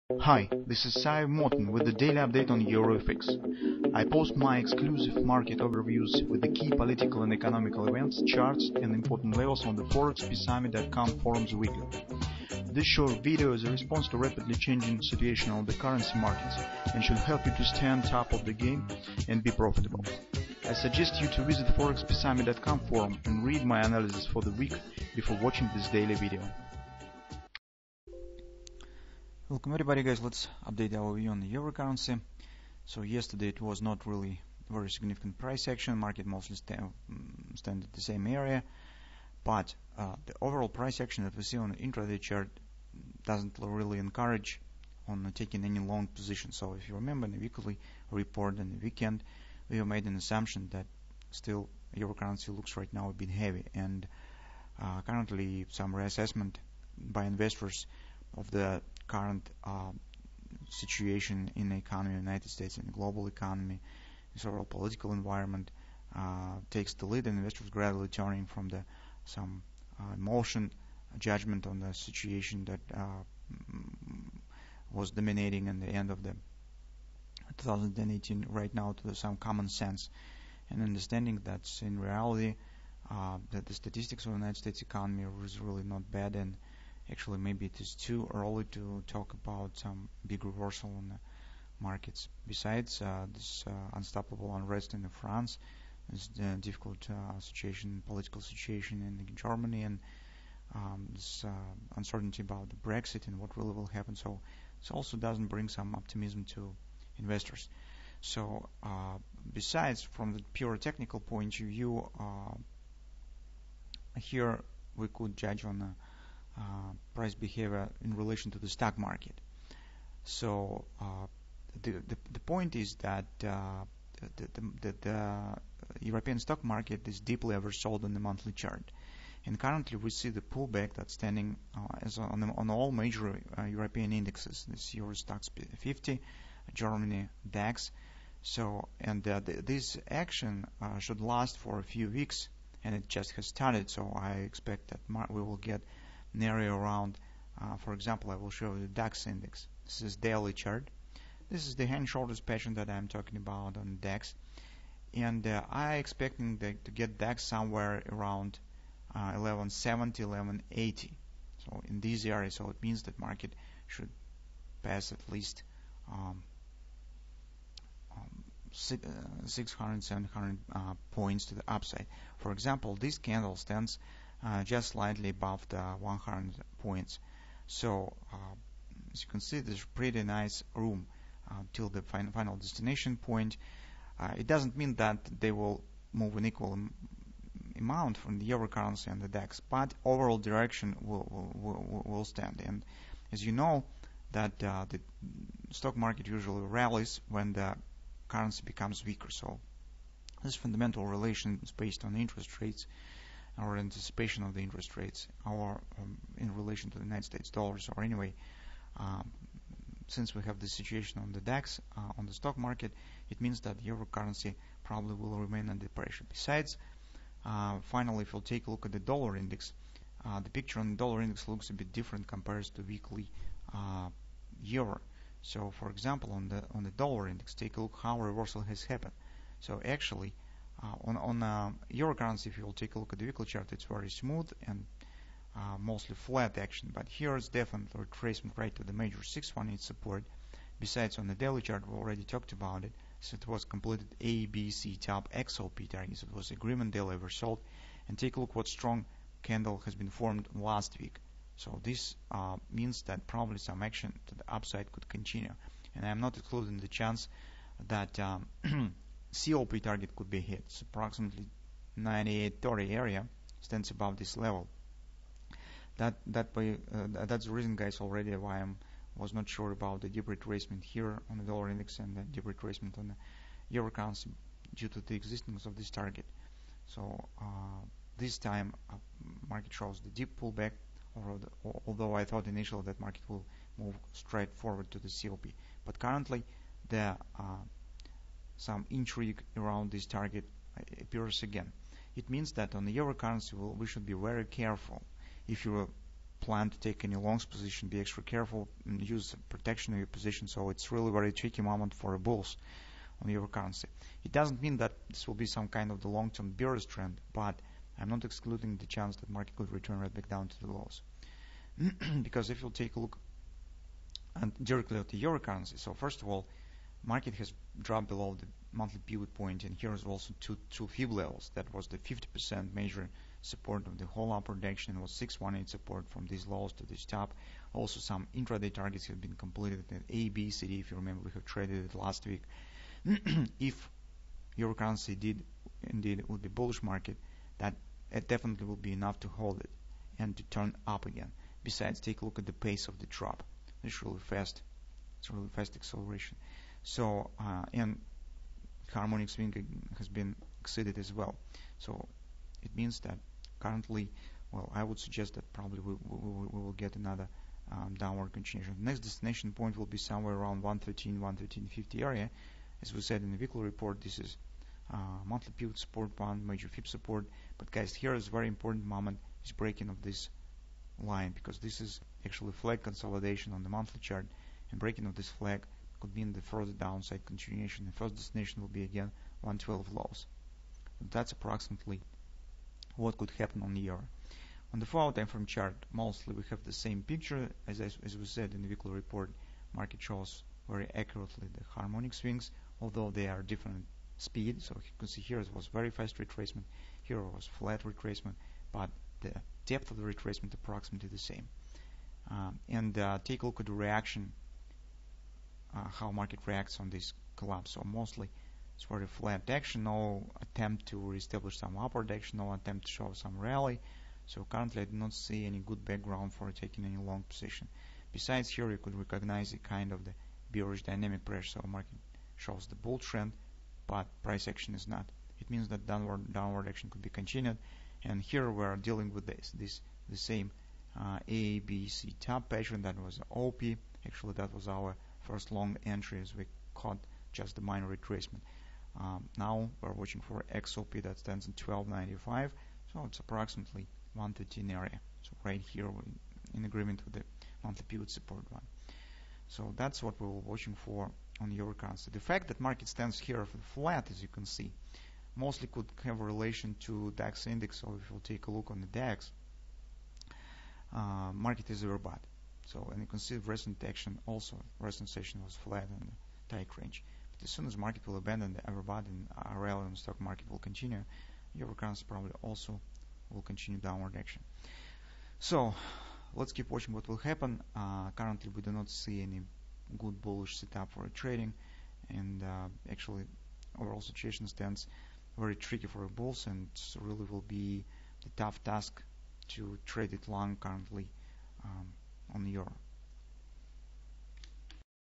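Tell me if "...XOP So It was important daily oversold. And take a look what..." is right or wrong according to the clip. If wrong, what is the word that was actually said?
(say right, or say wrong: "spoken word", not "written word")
wrong: "agreement", not "important".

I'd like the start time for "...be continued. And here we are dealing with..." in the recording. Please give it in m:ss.
7:07.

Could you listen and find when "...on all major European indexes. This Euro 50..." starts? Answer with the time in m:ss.
2:12.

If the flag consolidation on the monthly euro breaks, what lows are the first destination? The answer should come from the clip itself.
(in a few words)
112.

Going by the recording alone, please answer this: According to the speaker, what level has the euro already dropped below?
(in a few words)
monthly pivot point.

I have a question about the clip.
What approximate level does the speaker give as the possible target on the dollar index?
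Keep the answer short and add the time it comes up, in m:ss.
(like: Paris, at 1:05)
98.30, at 4:21.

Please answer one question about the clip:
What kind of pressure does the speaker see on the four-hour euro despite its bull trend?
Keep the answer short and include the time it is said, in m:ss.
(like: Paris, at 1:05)
bearish dynamic pressure, at 7:00.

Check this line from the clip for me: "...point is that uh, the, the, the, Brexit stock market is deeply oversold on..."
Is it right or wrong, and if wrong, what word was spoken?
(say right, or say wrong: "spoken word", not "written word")
wrong: "European", not "Brexit".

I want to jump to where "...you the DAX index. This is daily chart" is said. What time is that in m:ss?
2:28.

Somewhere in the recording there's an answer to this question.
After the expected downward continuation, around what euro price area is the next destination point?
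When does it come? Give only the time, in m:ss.
6:01.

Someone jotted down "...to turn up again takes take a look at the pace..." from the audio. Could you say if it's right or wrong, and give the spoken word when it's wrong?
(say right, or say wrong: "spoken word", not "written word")
wrong: "besides", not "takes".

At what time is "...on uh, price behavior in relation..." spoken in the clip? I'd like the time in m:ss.
1:55.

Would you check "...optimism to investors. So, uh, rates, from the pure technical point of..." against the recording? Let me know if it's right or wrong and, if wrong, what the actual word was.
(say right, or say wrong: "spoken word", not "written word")
wrong: "besides", not "rates".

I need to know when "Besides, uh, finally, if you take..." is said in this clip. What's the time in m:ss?
3:36.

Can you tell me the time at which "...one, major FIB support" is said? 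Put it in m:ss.
6:06.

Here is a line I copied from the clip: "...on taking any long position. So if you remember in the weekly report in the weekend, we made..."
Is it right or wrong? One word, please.
right.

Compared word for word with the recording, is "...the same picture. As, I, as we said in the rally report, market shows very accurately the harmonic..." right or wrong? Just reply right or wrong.
wrong.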